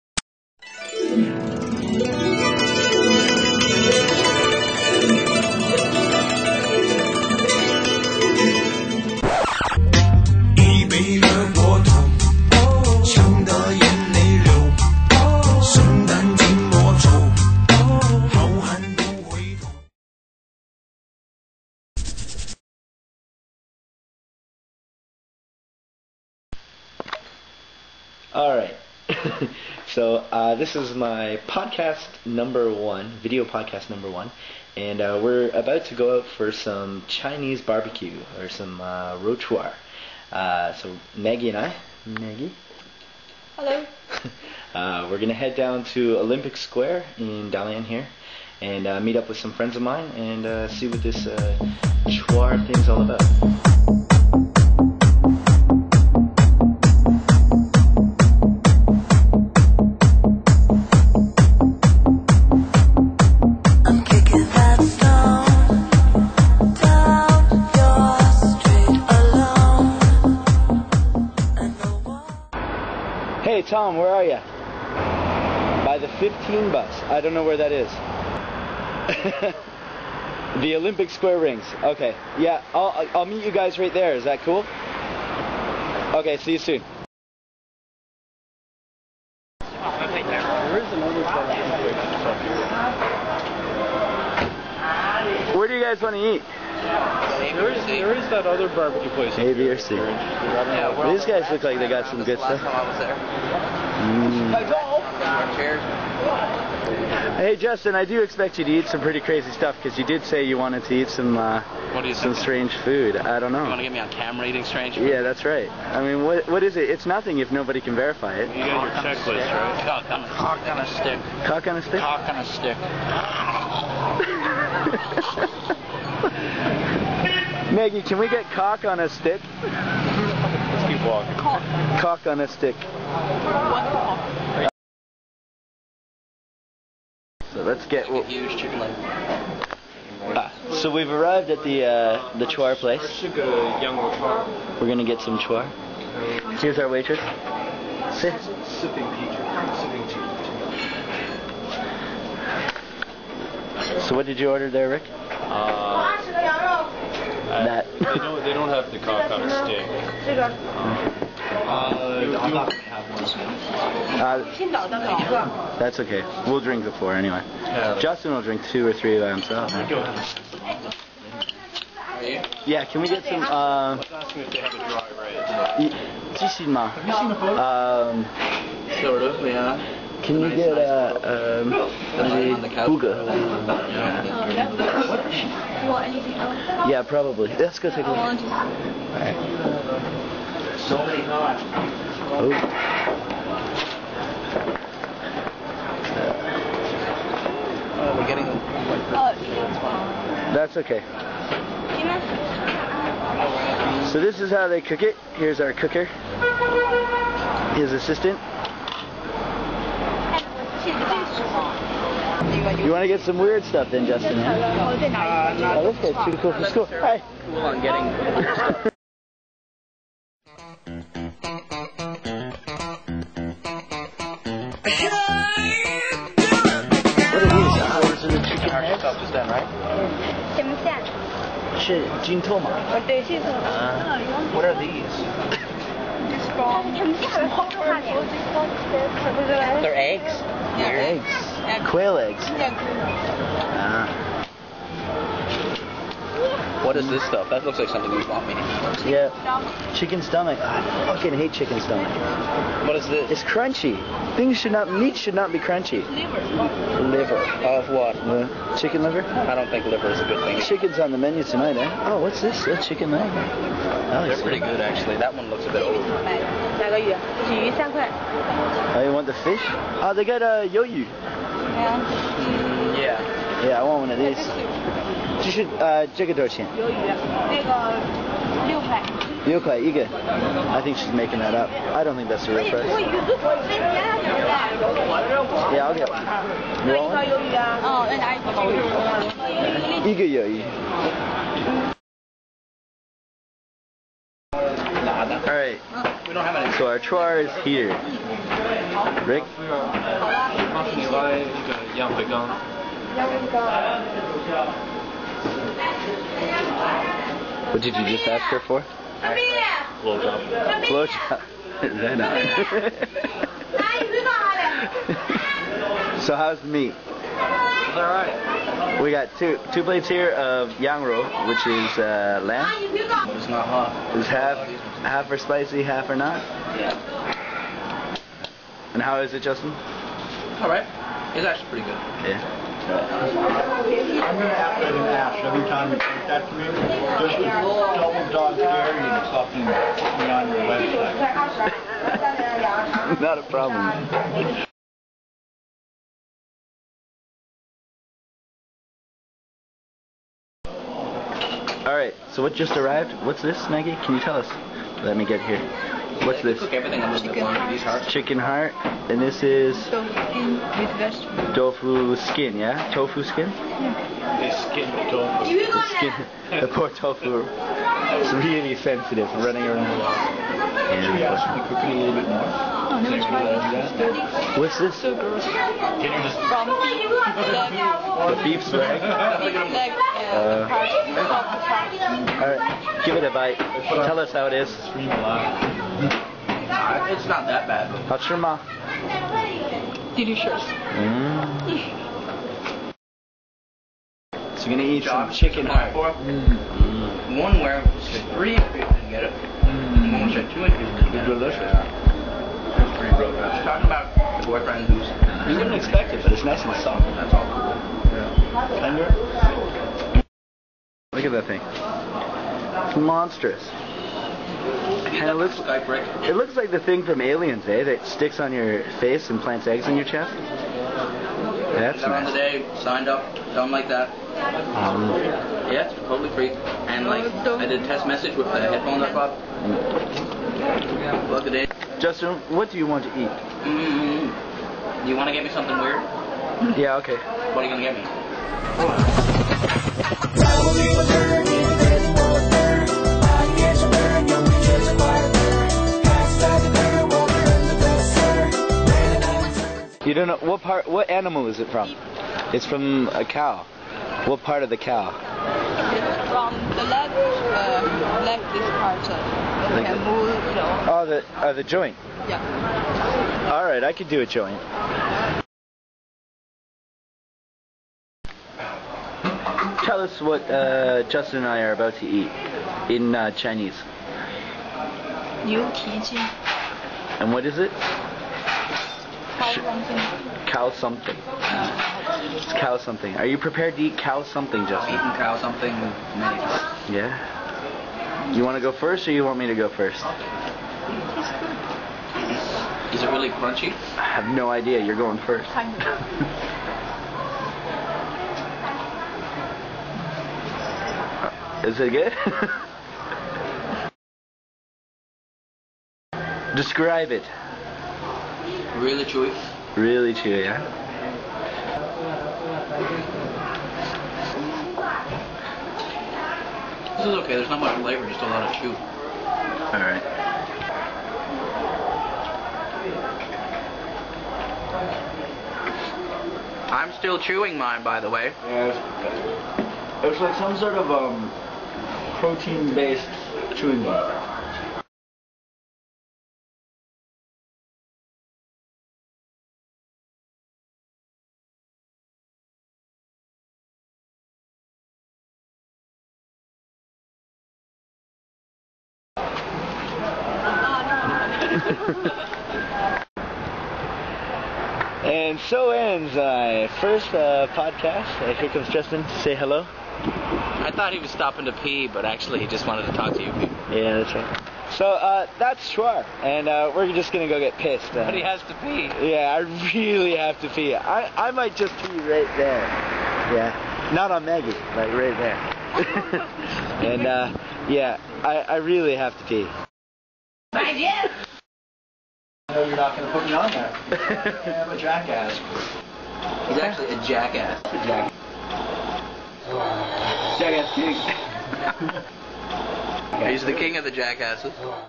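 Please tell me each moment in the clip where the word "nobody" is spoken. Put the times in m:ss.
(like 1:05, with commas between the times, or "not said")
1:57.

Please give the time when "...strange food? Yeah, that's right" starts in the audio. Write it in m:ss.
1:54.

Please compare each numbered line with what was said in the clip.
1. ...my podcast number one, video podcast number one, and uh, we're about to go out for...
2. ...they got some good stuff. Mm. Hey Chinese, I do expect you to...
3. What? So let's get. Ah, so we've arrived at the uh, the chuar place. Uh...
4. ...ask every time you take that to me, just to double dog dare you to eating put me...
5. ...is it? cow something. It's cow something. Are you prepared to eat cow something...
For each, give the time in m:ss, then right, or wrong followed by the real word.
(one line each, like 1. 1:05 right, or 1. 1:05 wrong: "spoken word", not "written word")
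1. 0:30 right
2. 1:41 wrong: "Justin", not "Chinese"
3. 2:13 right
4. 5:34 wrong: "fucking", not "eating"
5. 7:57 right.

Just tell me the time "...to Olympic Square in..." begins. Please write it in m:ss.
0:45.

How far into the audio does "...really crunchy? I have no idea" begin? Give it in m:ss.
8:13.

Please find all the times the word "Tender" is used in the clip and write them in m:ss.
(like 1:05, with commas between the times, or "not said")
6:48.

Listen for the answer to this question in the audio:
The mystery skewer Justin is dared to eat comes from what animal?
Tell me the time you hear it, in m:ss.
7:33.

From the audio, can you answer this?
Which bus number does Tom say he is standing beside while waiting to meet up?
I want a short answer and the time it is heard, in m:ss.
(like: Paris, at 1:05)
15, at 1:16.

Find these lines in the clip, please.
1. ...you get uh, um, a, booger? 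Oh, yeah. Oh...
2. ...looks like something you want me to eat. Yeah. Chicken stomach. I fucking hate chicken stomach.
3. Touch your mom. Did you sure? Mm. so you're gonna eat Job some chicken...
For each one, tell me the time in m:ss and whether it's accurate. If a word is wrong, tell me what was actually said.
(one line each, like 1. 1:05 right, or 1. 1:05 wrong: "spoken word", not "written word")
1. 3:00 right
2. 4:07 right
3. 6:28 right.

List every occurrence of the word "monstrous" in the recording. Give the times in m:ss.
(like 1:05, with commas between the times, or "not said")
6:52.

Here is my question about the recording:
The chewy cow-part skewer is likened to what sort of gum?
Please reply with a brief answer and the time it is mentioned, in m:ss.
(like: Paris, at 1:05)
Protein-based chewing gum, at 8:52.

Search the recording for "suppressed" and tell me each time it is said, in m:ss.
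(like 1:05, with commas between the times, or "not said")
not said.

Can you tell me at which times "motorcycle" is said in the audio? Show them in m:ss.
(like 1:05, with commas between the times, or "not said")
not said.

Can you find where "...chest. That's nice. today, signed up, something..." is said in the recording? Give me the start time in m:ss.
7:00.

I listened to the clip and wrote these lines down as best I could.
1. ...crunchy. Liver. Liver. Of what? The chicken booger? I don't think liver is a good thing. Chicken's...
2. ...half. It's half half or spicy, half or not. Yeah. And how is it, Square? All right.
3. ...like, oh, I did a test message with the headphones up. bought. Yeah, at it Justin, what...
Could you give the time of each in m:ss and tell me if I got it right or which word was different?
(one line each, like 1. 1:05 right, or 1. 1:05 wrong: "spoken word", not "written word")
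1. 4:15 wrong: "liver", not "booger"
2. 5:23 wrong: "Justin", not "Square"
3. 7:07 right.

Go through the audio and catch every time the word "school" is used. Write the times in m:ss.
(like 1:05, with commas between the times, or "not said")
3:36.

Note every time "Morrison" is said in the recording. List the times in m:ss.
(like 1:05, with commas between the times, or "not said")
not said.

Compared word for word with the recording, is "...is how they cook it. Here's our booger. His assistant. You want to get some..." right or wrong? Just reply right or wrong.
wrong.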